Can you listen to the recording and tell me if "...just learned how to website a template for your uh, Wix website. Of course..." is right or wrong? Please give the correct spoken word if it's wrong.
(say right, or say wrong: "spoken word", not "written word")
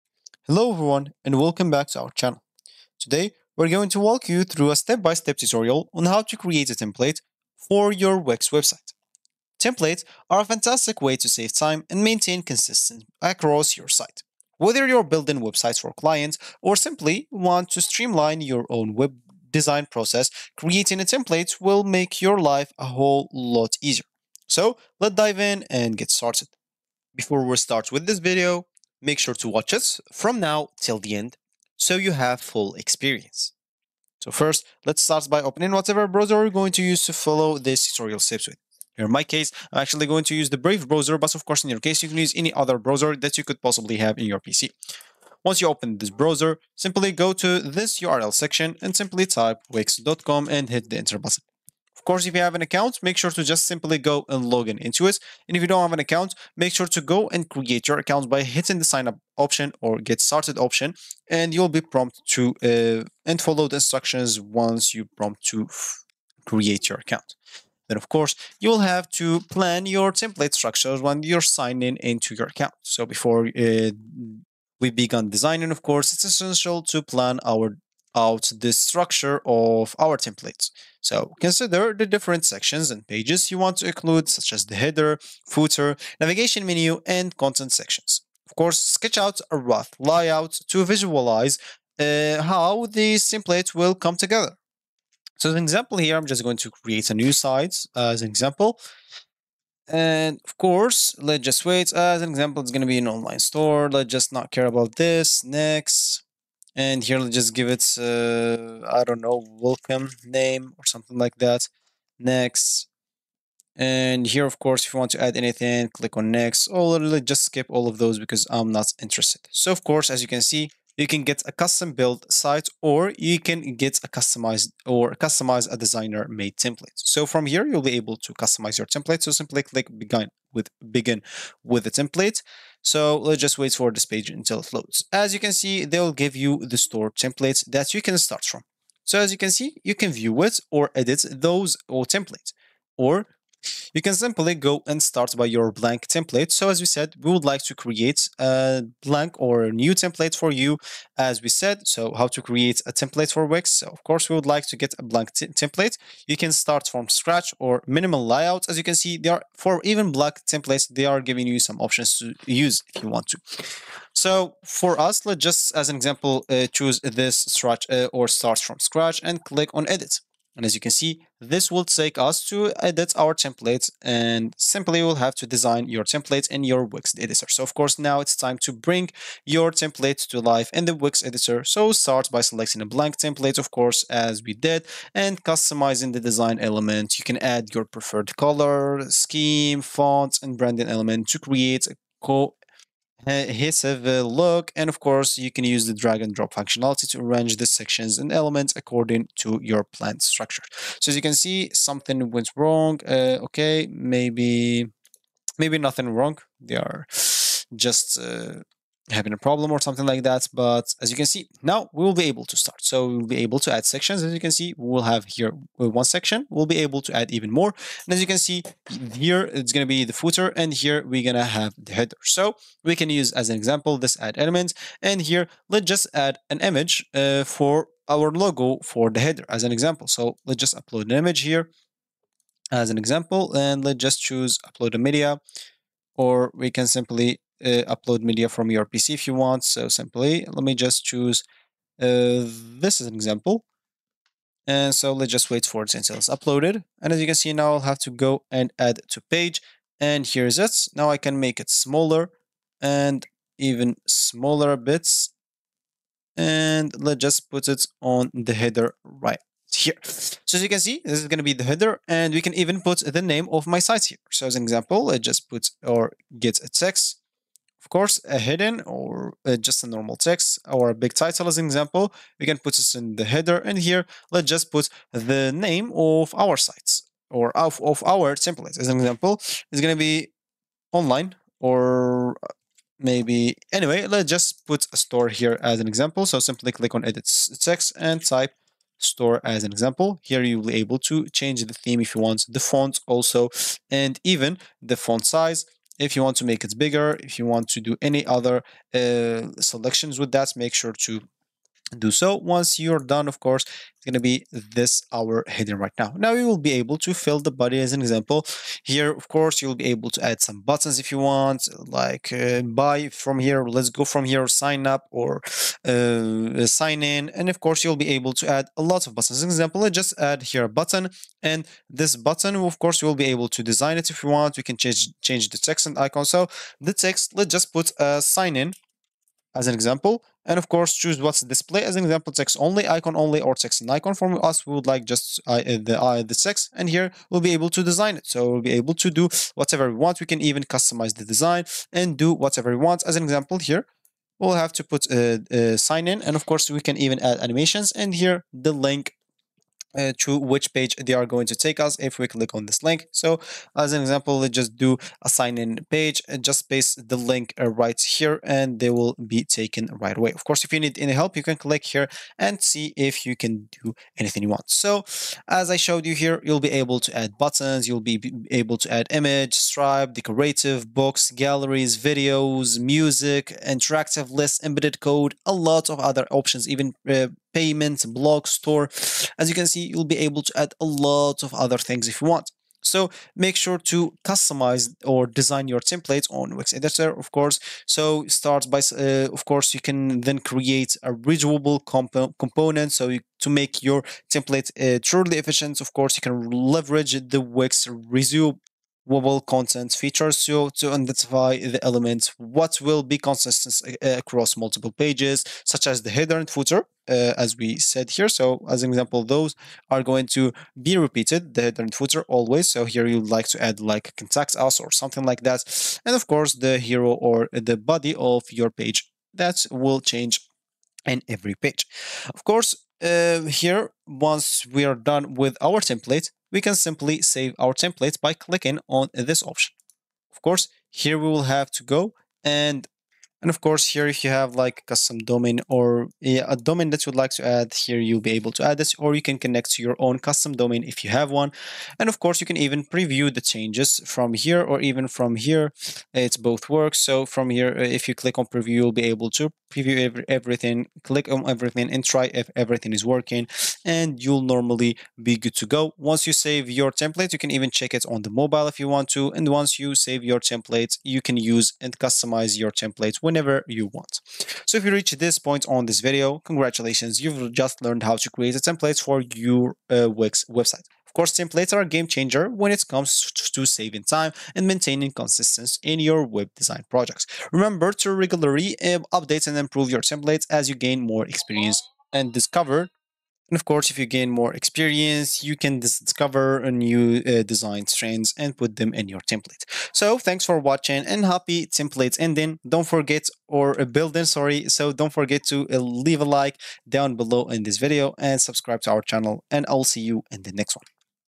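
wrong: "create", not "website".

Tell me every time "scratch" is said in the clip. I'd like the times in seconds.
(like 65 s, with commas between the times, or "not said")
157 s, 168 s.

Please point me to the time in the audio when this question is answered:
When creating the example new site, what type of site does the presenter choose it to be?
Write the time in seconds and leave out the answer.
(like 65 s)
103 s.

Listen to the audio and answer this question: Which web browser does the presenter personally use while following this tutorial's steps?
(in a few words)
Brave.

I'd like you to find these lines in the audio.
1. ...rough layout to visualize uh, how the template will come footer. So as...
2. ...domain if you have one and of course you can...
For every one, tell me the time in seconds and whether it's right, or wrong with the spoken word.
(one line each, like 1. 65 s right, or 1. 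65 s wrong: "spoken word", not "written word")
1. 89 s wrong: "together", not "footer"
2. 440 s right.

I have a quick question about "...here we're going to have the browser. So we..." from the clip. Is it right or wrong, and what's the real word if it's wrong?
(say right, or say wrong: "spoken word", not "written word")
wrong: "header", not "browser".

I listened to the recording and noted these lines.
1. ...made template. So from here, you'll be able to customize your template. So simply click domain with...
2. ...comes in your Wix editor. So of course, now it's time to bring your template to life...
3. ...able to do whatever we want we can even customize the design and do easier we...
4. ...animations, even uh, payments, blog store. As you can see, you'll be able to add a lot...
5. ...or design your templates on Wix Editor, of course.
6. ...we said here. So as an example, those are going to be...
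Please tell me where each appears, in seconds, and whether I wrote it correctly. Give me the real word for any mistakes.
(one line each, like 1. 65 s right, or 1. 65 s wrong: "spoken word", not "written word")
1. 126 s wrong: "begin", not "domain"
2. 176 s wrong: "templates", not "comes"
3. 338 s wrong: "whatever", not "easier"
4. 376 s wrong: "options", not "animations"
5. 385 s right
6. 407 s right.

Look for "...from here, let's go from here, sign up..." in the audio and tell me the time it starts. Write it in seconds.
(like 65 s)
313 s.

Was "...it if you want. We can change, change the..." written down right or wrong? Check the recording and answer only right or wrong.
right.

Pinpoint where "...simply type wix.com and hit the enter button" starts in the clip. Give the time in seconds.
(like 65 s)
48 s.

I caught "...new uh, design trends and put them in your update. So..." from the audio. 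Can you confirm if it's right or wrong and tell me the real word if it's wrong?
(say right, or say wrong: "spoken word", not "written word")
wrong: "template", not "update".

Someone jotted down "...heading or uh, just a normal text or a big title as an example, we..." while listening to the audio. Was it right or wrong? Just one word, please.
right.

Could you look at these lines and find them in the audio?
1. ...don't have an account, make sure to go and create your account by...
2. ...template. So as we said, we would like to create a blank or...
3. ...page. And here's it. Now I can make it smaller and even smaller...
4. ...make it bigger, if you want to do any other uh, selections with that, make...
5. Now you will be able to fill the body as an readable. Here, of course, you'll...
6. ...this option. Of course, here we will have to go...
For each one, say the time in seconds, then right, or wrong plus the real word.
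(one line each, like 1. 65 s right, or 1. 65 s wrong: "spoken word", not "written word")
1. 55 s right
2. 146 s right
3. 249 s right
4. 296 s right
5. 306 s wrong: "example", not "readable"
6. 429 s right.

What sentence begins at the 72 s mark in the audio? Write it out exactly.
So before uh, we begin designing, of course, it's essential to plan our out the structure of our templates.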